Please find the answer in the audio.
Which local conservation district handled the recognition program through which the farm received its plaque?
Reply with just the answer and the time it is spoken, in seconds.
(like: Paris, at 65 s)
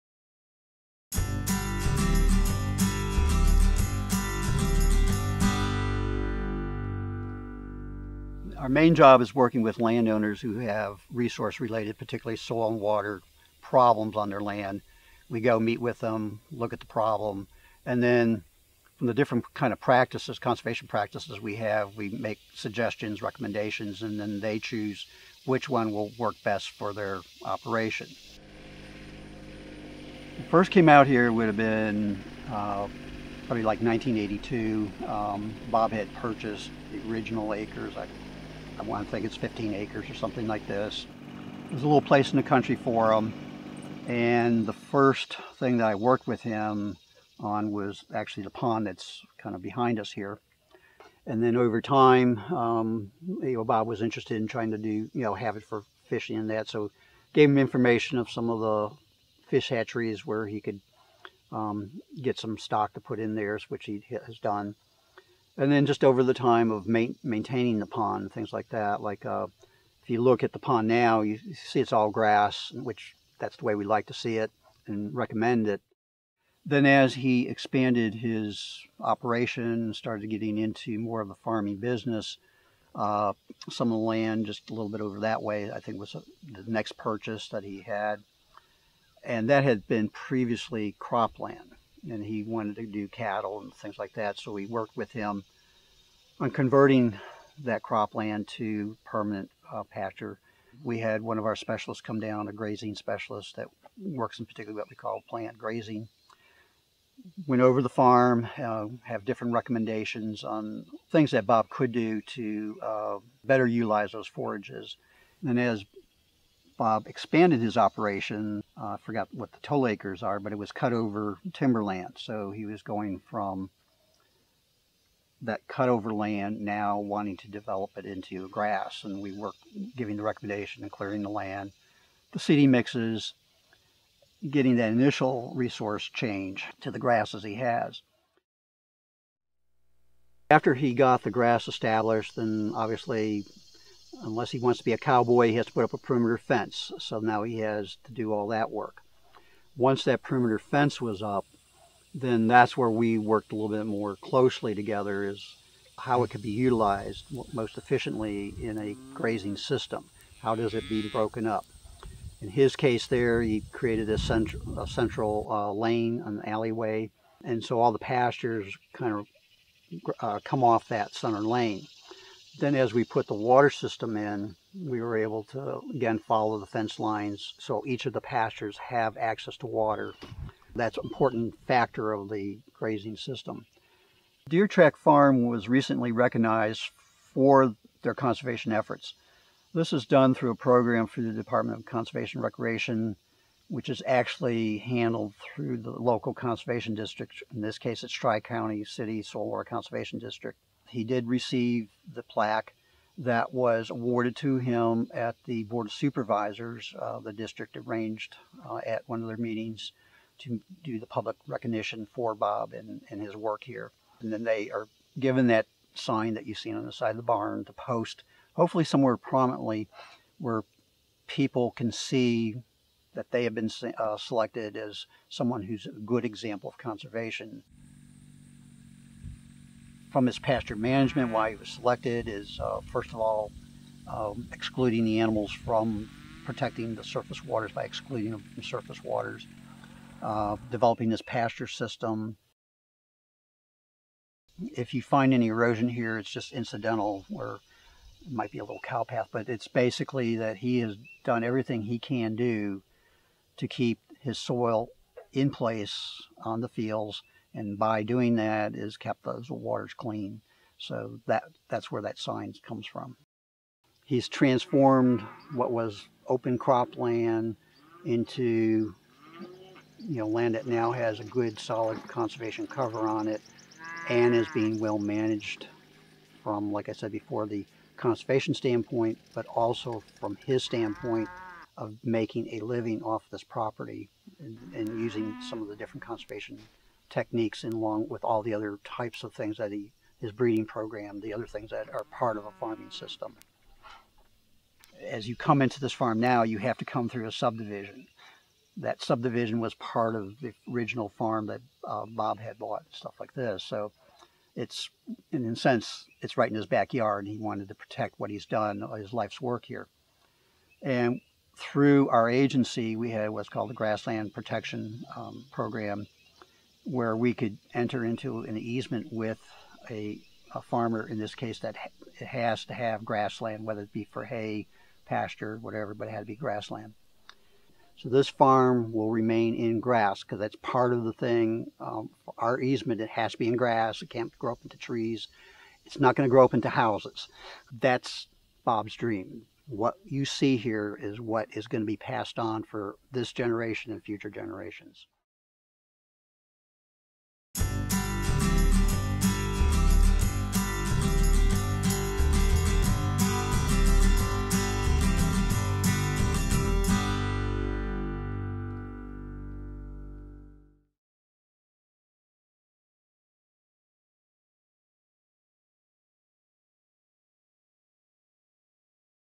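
Tri County City Soil Water Conservation District, at 198 s.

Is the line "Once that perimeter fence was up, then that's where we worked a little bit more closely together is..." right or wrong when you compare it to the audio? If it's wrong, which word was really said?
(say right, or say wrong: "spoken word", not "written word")
right.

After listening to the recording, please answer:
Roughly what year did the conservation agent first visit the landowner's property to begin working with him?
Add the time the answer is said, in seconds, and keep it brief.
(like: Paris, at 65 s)
1982, at 33 s.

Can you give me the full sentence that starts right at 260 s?
So that, that's where that sign comes from.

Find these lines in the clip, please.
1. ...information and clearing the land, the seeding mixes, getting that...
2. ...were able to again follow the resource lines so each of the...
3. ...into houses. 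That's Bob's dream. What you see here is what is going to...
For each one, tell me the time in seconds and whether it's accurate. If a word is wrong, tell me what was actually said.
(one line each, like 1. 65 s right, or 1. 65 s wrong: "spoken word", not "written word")
1. 130 s wrong: "recommendation", not "information"
2. 174 s wrong: "fence", not "resource"
3. 336 s right.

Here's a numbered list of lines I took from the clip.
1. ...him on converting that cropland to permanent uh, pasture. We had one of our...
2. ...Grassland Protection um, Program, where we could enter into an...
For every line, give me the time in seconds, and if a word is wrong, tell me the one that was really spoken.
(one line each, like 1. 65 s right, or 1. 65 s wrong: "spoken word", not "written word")
1. 95 s right
2. 313 s right.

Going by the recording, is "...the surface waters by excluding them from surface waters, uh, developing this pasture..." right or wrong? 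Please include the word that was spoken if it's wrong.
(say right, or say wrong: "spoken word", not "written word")
right.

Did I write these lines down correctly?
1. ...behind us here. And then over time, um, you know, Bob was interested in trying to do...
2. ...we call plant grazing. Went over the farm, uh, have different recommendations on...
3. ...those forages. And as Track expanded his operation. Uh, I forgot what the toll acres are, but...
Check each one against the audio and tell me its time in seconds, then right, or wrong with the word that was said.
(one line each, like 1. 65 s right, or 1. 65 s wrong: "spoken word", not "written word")
1. 49 s right
2. 104 s right
3. 114 s wrong: "Bob", not "Track".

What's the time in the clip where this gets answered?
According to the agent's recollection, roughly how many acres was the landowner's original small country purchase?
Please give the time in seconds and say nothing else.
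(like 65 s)
39 s.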